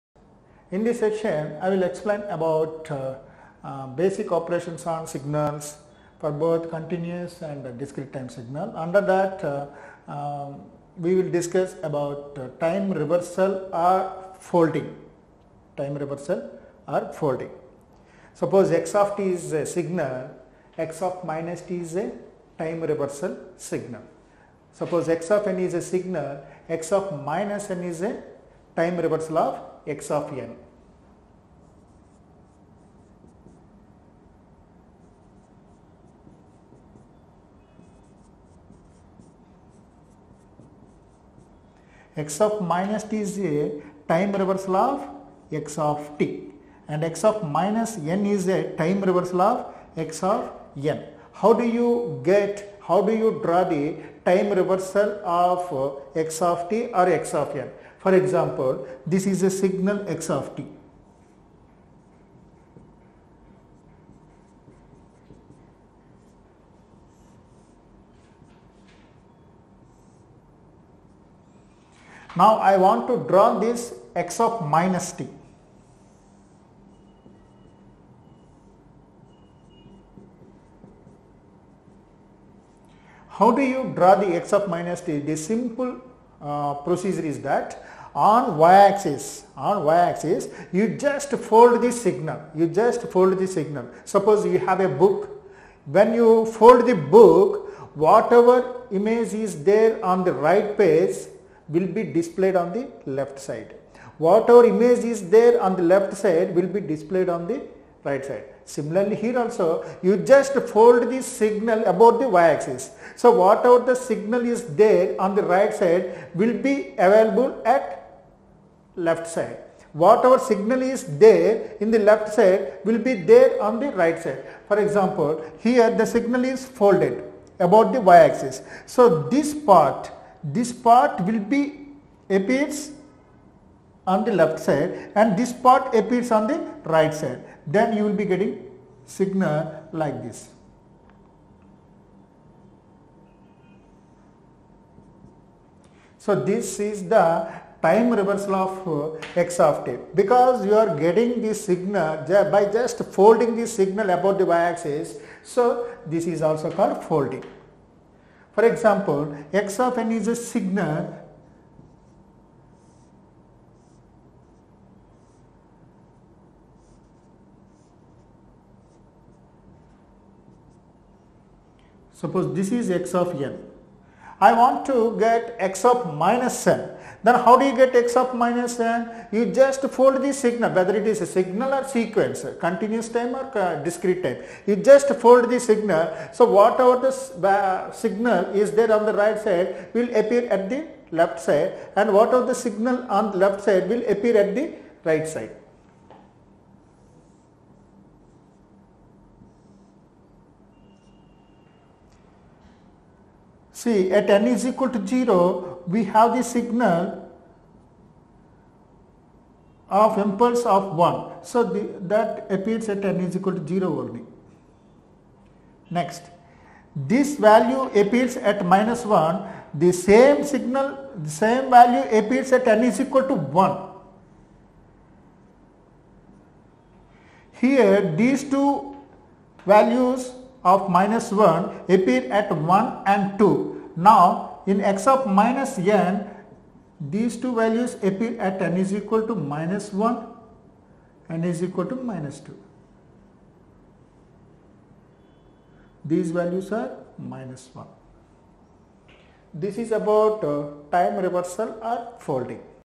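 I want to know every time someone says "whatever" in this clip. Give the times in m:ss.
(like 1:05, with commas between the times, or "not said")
1:38, 1:44, 1:53, 1:59, 3:06, 3:12.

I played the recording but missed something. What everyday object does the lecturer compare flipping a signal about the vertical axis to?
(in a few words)
A book.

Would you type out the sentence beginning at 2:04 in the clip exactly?
For example, here the signal is folded about the y-axis.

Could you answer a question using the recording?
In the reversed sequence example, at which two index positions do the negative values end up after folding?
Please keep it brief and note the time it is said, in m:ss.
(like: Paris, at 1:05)
-1 and -2, at 3:59.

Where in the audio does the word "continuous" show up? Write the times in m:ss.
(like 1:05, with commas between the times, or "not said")
0:06, 3:02.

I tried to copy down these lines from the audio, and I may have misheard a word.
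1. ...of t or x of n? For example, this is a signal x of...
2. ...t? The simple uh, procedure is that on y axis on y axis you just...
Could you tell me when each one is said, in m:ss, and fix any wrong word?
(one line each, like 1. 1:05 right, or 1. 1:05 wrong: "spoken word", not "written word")
1. 0:56 right
2. 1:25 right.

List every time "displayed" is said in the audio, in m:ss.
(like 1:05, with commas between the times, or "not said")
1:42, 1:46.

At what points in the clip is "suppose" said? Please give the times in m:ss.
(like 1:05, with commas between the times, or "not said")
0:18, 0:24, 1:34, 2:52.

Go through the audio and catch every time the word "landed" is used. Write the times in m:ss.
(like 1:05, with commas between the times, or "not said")
not said.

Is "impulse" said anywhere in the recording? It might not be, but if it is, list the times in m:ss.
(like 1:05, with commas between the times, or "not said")
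3:30.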